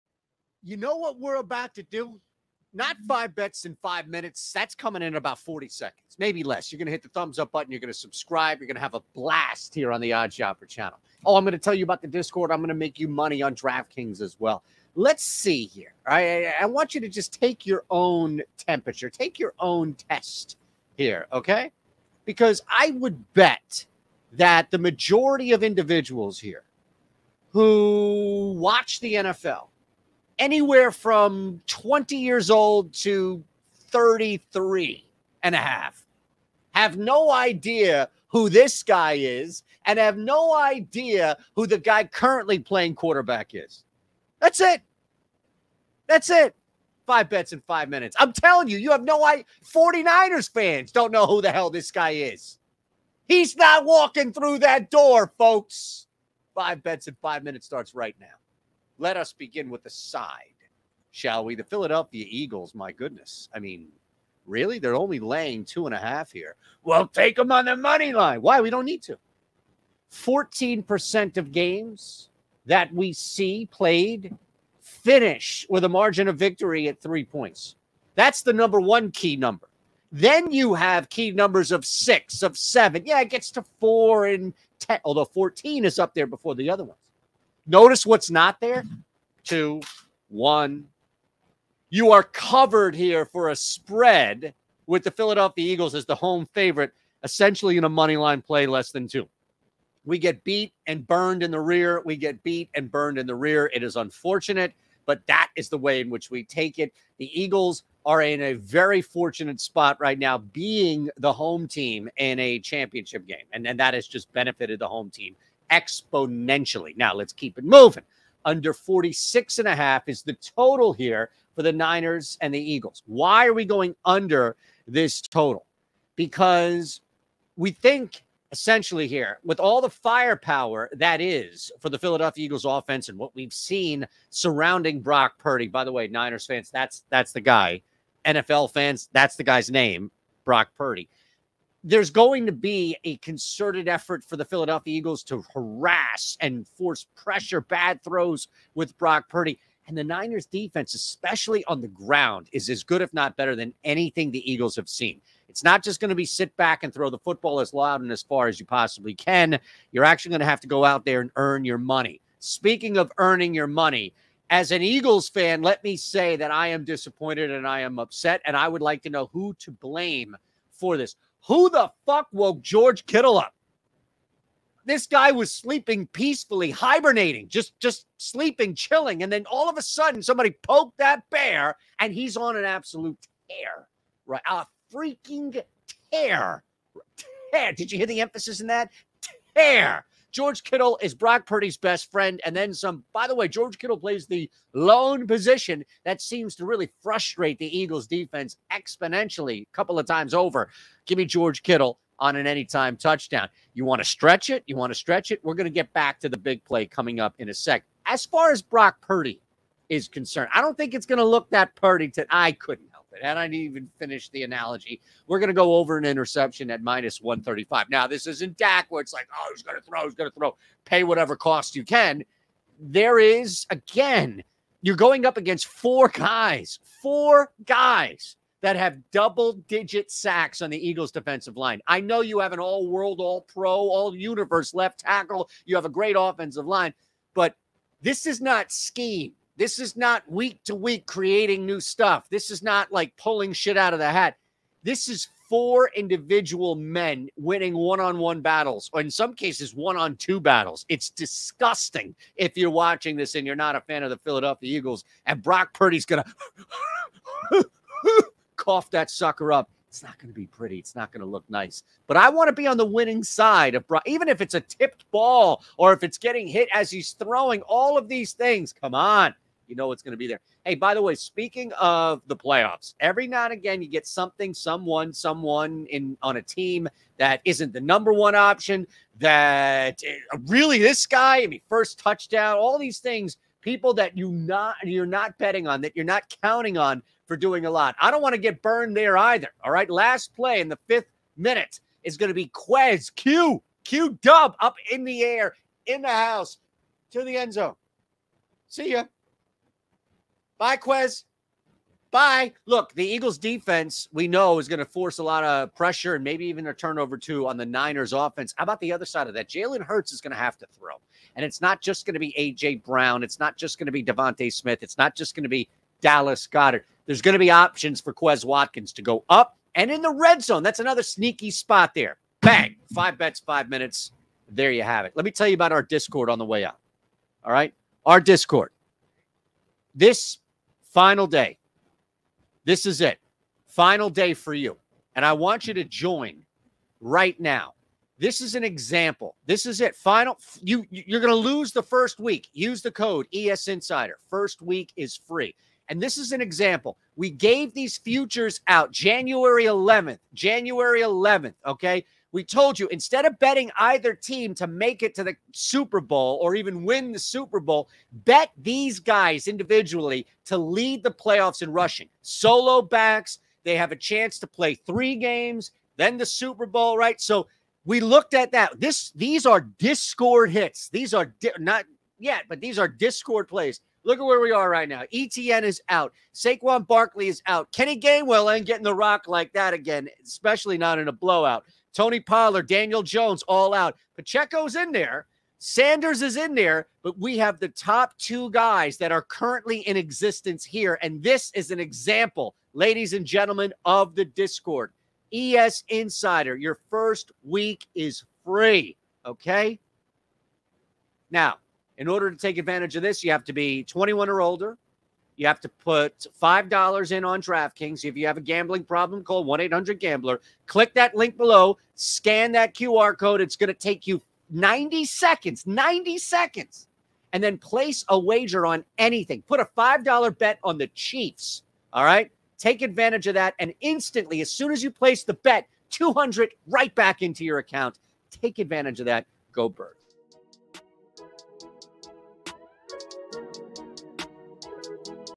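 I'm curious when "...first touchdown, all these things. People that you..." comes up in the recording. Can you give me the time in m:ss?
4:41.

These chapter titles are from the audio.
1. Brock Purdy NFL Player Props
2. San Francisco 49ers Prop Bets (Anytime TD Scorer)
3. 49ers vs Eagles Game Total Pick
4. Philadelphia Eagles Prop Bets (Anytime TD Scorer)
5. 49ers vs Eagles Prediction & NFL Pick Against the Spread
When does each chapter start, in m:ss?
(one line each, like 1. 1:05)
1. 3:55
2. 2:55
3. 1:55
4. 4:55
5. 0:55.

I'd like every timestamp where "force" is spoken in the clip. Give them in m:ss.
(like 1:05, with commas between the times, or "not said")
2:26, 5:04.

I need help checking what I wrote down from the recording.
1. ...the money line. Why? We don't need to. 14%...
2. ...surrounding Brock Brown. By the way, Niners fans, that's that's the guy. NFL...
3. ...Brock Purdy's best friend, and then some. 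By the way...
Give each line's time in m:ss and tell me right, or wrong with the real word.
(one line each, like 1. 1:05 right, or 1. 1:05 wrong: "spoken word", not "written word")
1. 1:07 right
2. 2:14 wrong: "Purdy", not "Brown"
3. 3:11 right.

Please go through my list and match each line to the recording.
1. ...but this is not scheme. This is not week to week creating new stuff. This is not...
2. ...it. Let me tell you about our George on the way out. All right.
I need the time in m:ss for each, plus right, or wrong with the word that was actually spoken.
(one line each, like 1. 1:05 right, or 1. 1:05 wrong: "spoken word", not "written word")
1. 3:57 right
2. 5:25 wrong: "Discord", not "George".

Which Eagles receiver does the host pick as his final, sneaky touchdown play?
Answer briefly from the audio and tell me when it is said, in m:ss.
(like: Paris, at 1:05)
Quez Watkins, at 5:18.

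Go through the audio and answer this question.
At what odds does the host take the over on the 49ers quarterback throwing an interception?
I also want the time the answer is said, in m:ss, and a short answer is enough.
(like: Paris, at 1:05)
-135, at 3:36.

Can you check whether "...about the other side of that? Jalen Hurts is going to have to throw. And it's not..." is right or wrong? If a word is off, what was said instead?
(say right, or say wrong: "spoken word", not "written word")
right.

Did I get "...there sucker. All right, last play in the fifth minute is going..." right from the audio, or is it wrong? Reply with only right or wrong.
wrong.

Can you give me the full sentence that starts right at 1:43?
It is unfortunate, but that is the way in which we take it.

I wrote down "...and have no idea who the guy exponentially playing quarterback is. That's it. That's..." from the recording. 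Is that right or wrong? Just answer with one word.
wrong.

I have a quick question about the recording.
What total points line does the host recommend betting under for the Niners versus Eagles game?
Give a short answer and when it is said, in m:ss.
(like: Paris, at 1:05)
46.5, at 1:58.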